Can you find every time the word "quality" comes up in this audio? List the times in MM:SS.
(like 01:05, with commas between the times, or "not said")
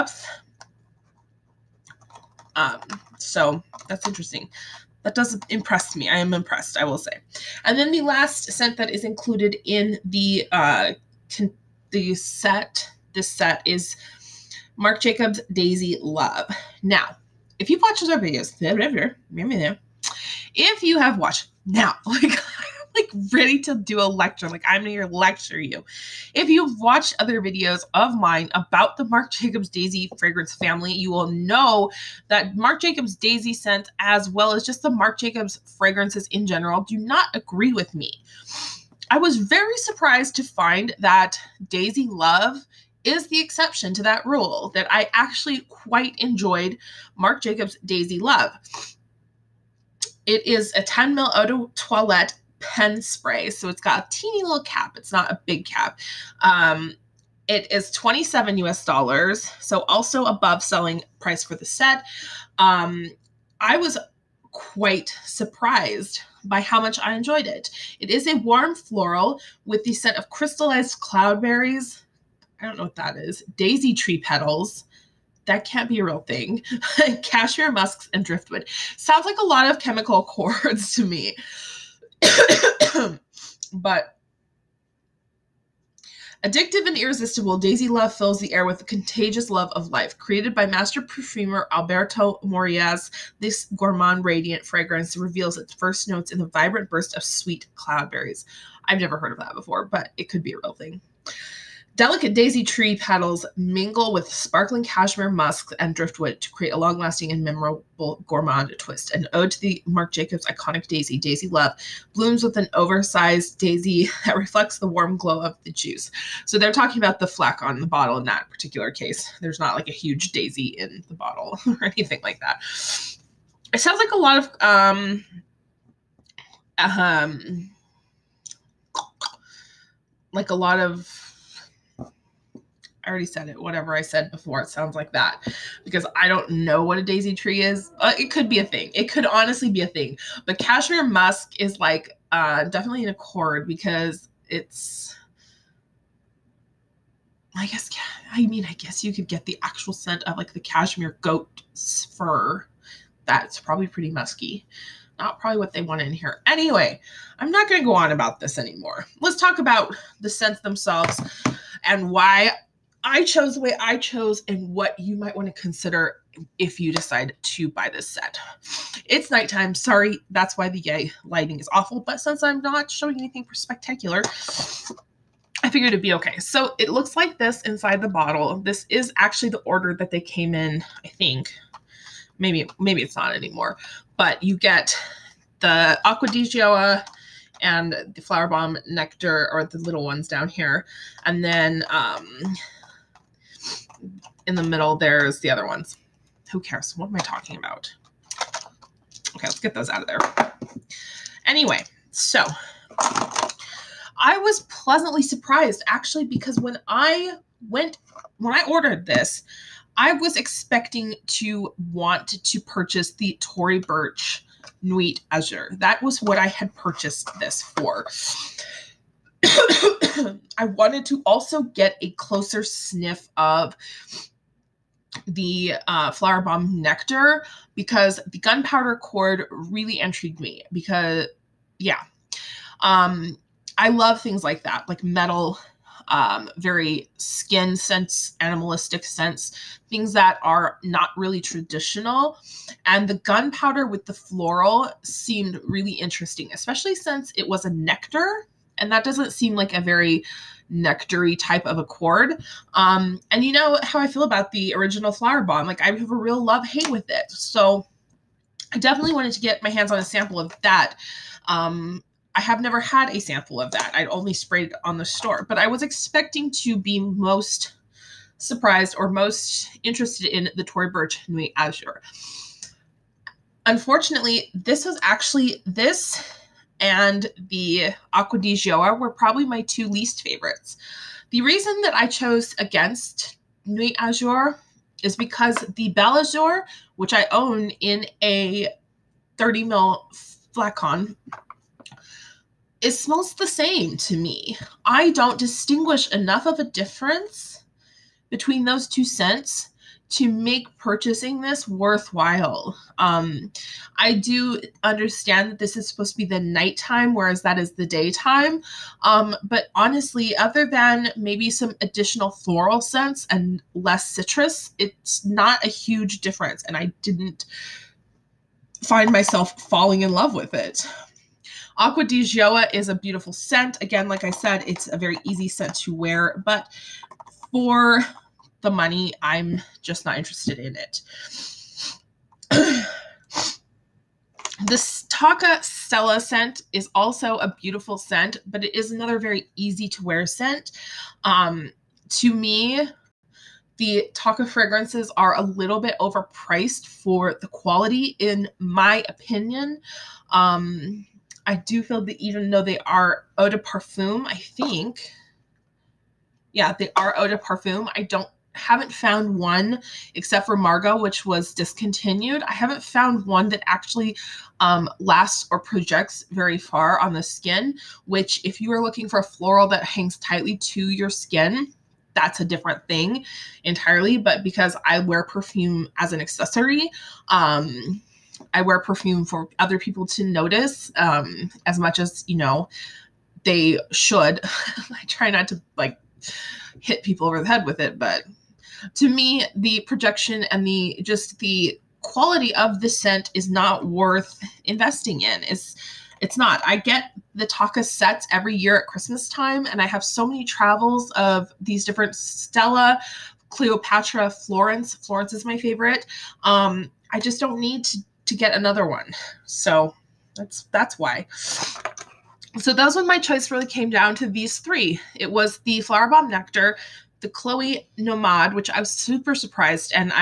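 05:47, 06:32.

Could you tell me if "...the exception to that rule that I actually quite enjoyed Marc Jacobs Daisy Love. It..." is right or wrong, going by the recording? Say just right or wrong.
right.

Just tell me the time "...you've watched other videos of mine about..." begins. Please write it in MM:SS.
00:26.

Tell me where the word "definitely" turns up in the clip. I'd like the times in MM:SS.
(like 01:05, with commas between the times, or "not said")
02:22, 04:18.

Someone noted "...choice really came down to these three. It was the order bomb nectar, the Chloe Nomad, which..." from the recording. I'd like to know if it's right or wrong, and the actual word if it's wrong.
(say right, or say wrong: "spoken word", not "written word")
wrong: "flower", not "order".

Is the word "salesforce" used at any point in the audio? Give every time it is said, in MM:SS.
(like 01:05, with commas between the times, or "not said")
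not said.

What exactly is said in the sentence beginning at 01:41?
Delicate daisy tree petals mingle with sparkling cashmere musk and driftwood to create a long lasting and memorable gourmand twist.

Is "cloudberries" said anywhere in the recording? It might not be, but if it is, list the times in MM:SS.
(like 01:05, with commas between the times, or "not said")
01:11, 01:37.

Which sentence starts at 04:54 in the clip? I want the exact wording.
I don't distinguish enough of a difference between those two scents to make purchasing this worthwhile.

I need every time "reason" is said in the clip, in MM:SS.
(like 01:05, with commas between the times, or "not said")
04:41.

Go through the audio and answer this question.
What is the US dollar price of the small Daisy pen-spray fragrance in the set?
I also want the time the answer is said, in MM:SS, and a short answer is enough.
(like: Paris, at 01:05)
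27, at 00:57.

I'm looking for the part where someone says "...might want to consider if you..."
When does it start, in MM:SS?
02:45.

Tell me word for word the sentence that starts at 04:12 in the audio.
Um, and you know how I feel about the original flower bomb.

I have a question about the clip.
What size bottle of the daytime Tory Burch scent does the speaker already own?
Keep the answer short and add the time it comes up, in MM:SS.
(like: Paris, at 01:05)
30 ml, at 04:49.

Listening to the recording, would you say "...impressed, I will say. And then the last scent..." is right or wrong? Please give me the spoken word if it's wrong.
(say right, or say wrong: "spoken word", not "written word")
right.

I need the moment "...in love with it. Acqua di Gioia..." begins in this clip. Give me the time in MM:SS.
05:20.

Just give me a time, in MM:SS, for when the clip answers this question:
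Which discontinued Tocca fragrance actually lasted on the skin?
06:00.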